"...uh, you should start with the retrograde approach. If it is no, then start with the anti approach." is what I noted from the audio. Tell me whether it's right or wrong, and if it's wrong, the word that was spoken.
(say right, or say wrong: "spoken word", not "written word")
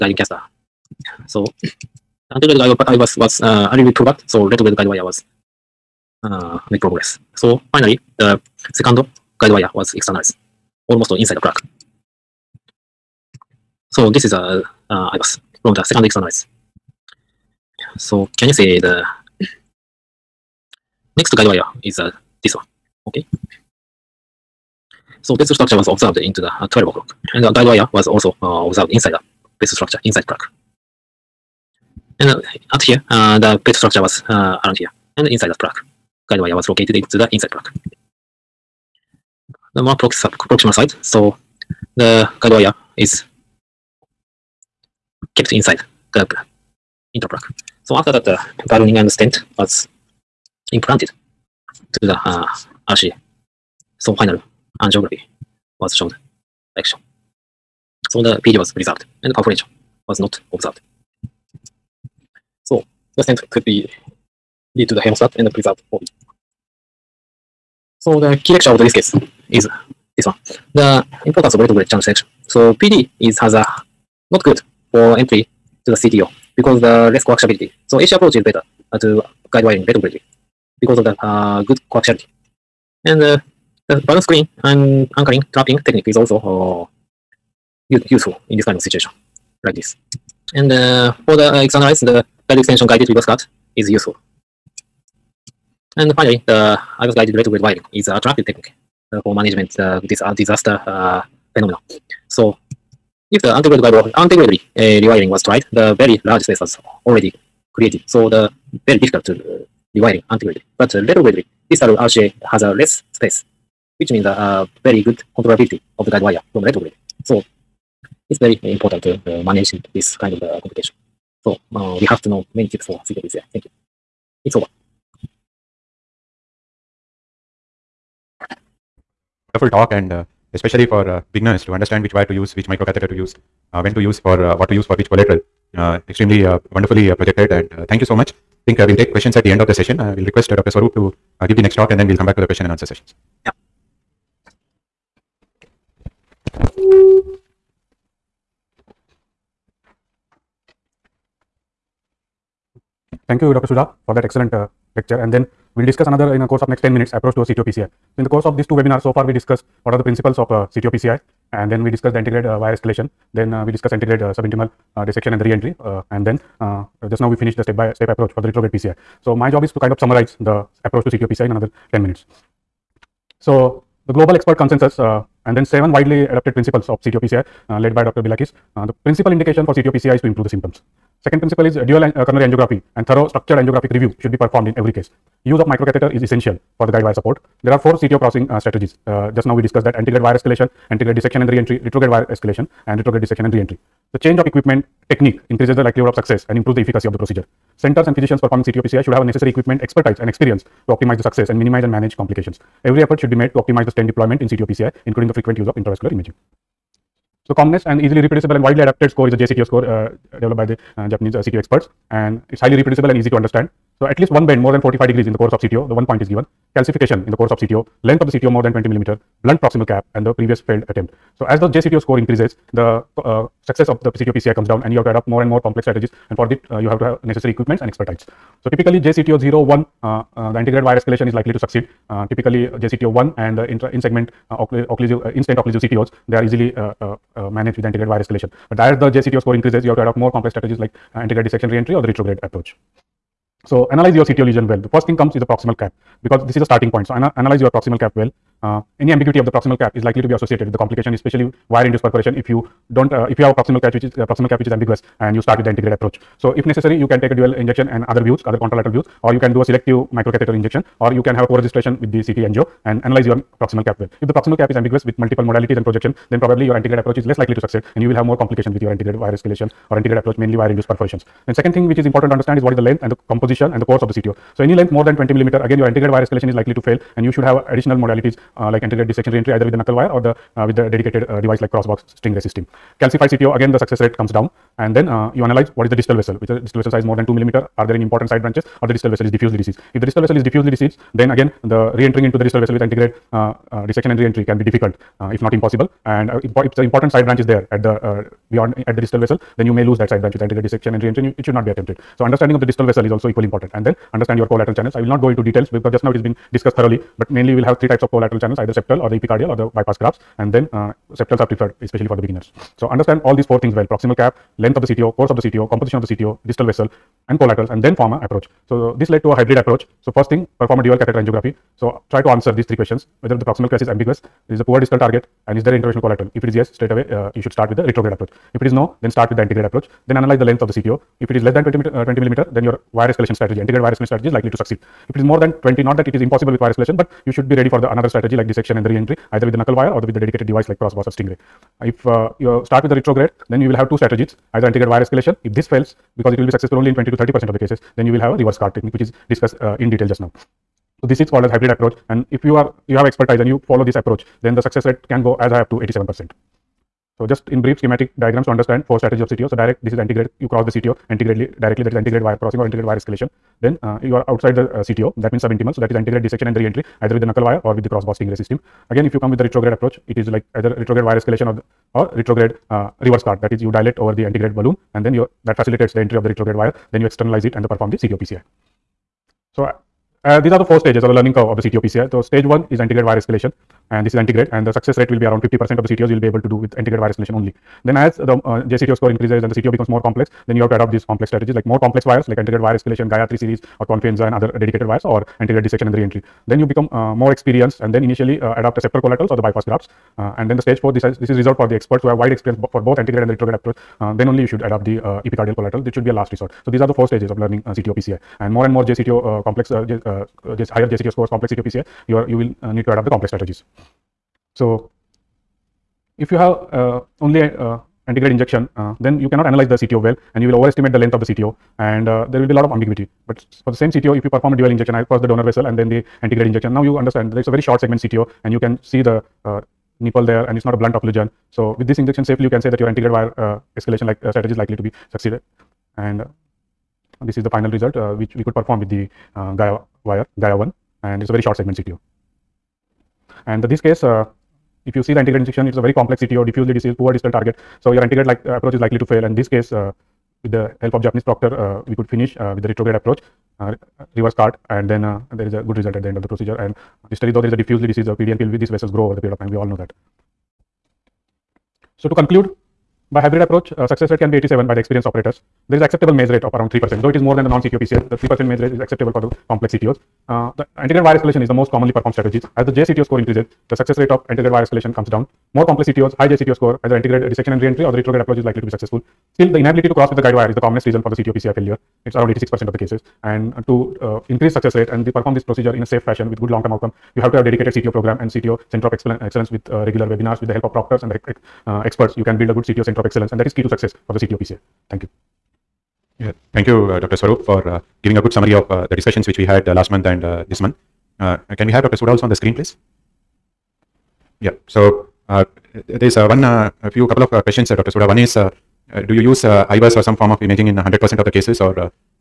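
right.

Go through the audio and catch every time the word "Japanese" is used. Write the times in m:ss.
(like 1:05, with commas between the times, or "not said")
3:31, 7:31.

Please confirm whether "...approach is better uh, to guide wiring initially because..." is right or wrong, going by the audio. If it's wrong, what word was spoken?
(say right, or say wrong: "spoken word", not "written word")
wrong: "retrogradely", not "initially".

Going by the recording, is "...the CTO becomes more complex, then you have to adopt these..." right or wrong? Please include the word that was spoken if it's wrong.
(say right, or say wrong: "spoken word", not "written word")
right.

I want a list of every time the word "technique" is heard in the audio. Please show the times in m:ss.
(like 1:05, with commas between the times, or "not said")
1:25, 1:38, 3:15, 5:48.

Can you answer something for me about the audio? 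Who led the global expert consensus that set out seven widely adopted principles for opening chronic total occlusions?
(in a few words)
Dr. Brilakis.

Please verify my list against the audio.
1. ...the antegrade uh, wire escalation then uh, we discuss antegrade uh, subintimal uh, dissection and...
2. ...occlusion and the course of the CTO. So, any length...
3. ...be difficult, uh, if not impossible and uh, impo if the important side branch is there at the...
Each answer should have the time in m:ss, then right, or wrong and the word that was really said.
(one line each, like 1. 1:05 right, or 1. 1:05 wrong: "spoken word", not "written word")
1. 2:42 right
2. 4:33 wrong: "composition", not "occlusion"
3. 4:54 right.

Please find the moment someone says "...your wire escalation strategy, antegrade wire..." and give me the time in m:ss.
5:32.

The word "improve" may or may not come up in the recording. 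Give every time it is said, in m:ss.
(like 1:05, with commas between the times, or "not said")
3:00, 3:16.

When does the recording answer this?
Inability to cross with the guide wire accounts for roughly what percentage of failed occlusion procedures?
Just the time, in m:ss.
8:02.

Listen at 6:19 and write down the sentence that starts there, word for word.
So, uh, uh, these are the four stages or the learning curve of the CTO PCI.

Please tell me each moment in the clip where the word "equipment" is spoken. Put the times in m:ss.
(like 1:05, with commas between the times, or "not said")
3:14, 3:19, 3:47.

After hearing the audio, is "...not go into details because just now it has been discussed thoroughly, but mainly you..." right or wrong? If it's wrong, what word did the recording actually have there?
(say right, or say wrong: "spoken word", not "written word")
right.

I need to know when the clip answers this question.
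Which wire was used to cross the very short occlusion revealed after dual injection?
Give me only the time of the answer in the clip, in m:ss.
7:20.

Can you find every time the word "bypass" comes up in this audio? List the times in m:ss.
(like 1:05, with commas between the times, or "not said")
5:09, 6:39.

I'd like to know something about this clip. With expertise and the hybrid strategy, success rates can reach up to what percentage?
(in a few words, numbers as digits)
87 percent.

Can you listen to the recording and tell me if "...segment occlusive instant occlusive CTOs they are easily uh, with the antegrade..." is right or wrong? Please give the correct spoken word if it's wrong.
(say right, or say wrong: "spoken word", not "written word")
right.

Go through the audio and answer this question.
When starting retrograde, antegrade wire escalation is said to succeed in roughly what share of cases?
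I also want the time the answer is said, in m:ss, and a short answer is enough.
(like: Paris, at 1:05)
20 to 30 percent, at 5:46.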